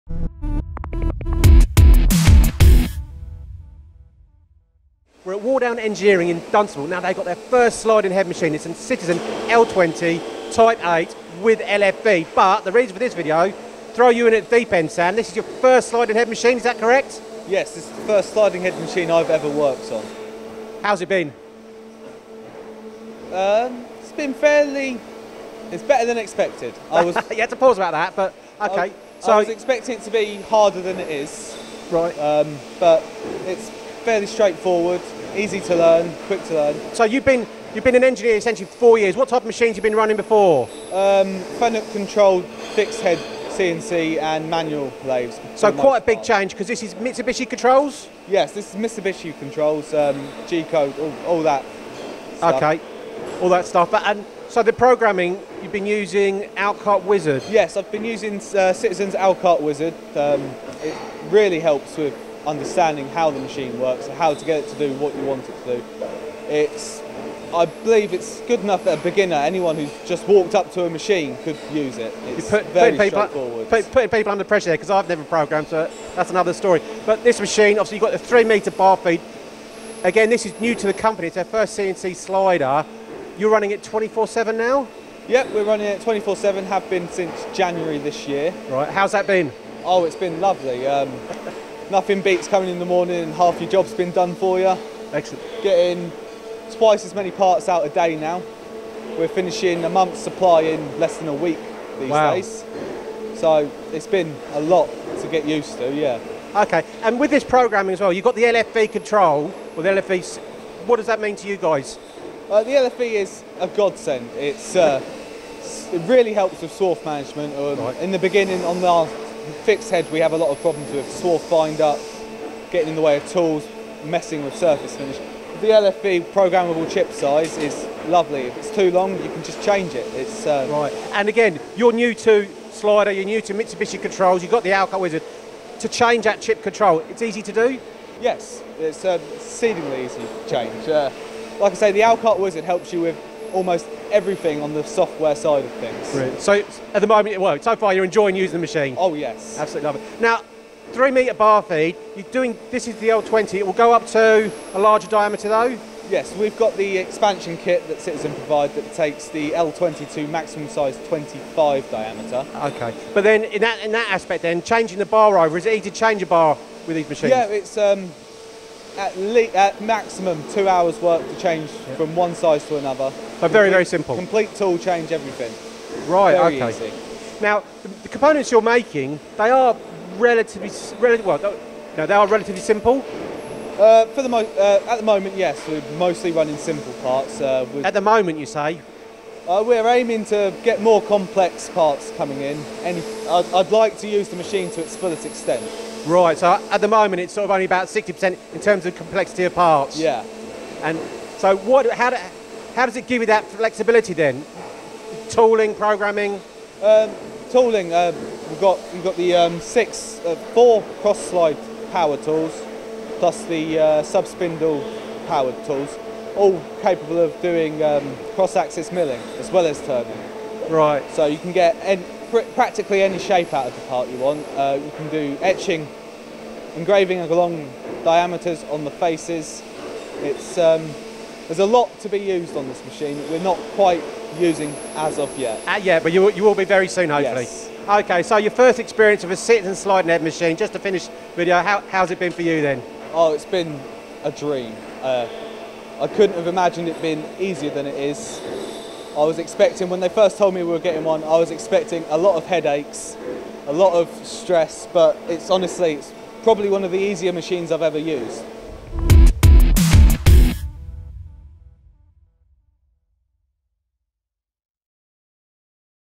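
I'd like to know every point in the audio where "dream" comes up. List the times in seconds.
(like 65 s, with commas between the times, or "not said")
244 s.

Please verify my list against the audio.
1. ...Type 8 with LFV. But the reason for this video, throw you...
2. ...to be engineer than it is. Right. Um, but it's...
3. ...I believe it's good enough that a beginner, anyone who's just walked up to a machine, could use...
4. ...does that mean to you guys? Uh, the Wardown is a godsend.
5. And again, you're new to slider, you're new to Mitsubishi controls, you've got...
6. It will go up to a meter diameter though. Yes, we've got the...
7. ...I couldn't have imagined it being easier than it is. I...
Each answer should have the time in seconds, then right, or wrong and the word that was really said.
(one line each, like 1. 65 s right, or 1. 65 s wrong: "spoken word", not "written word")
1. 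10 s right
2. 30 s wrong: "harder", not "engineer"
3. 67 s right
4. 110 s wrong: "LFV", not "Wardown"
5. 131 s right
6. 153 s wrong: "larger", not "meter"
7. 245 s right.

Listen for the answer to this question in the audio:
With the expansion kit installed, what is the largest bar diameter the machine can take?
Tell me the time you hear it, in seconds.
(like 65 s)
161 s.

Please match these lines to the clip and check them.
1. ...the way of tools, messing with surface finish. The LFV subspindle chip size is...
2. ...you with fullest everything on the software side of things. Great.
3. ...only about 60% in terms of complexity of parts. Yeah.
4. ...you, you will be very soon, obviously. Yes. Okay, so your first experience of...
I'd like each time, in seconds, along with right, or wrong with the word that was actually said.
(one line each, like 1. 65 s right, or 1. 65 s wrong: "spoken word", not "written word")
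1. 122 s wrong: "programmable", not "subspindle"
2. 142 s wrong: "almost", not "fullest"
3. 197 s right
4. 236 s wrong: "hopefully", not "obviously".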